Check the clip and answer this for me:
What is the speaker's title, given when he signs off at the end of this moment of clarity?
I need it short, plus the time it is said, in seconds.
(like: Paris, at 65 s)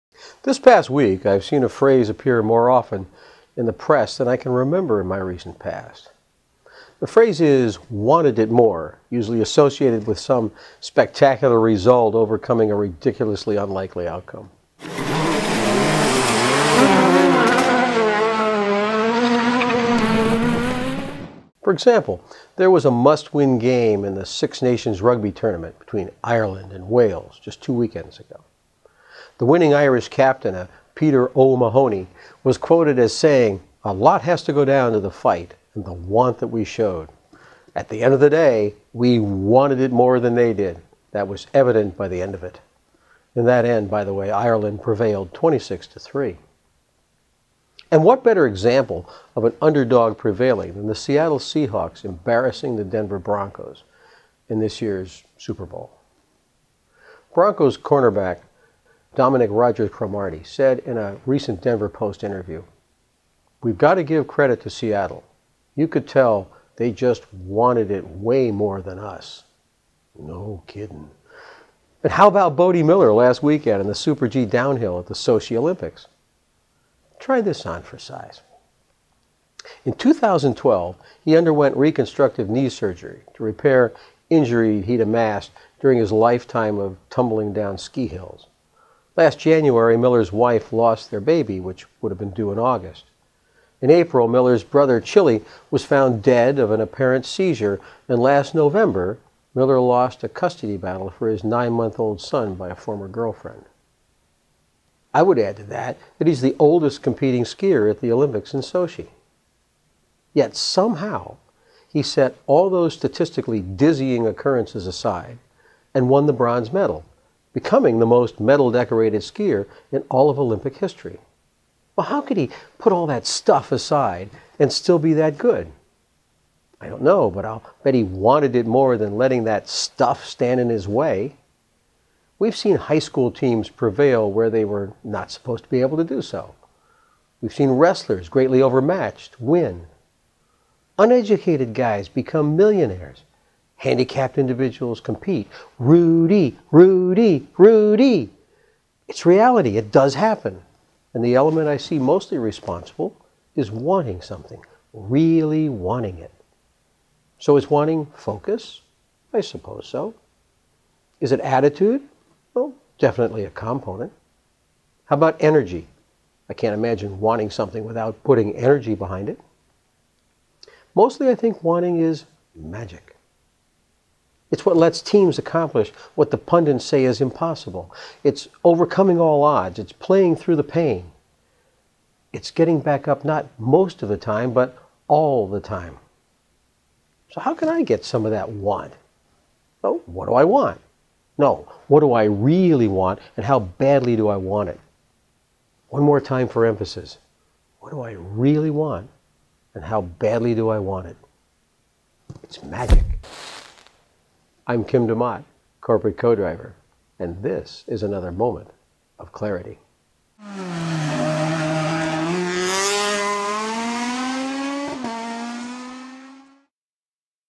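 Corporate Co-Driver, at 205 s.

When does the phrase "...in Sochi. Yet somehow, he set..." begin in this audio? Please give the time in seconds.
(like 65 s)
108 s.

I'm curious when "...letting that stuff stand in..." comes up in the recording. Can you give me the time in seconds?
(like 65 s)
129 s.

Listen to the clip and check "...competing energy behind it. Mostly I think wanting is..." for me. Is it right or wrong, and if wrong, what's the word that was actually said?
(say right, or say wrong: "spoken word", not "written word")
wrong: "putting", not "competing".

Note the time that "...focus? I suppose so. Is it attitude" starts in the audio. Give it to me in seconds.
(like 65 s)
158 s.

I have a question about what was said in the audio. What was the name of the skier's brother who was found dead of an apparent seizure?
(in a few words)
Chilly.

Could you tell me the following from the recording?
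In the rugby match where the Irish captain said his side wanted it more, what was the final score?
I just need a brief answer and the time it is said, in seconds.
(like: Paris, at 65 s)
26 to 3, at 45 s.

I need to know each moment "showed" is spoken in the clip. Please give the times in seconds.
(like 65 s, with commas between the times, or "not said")
36 s.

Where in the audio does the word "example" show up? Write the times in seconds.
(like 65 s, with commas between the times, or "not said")
21 s, 48 s.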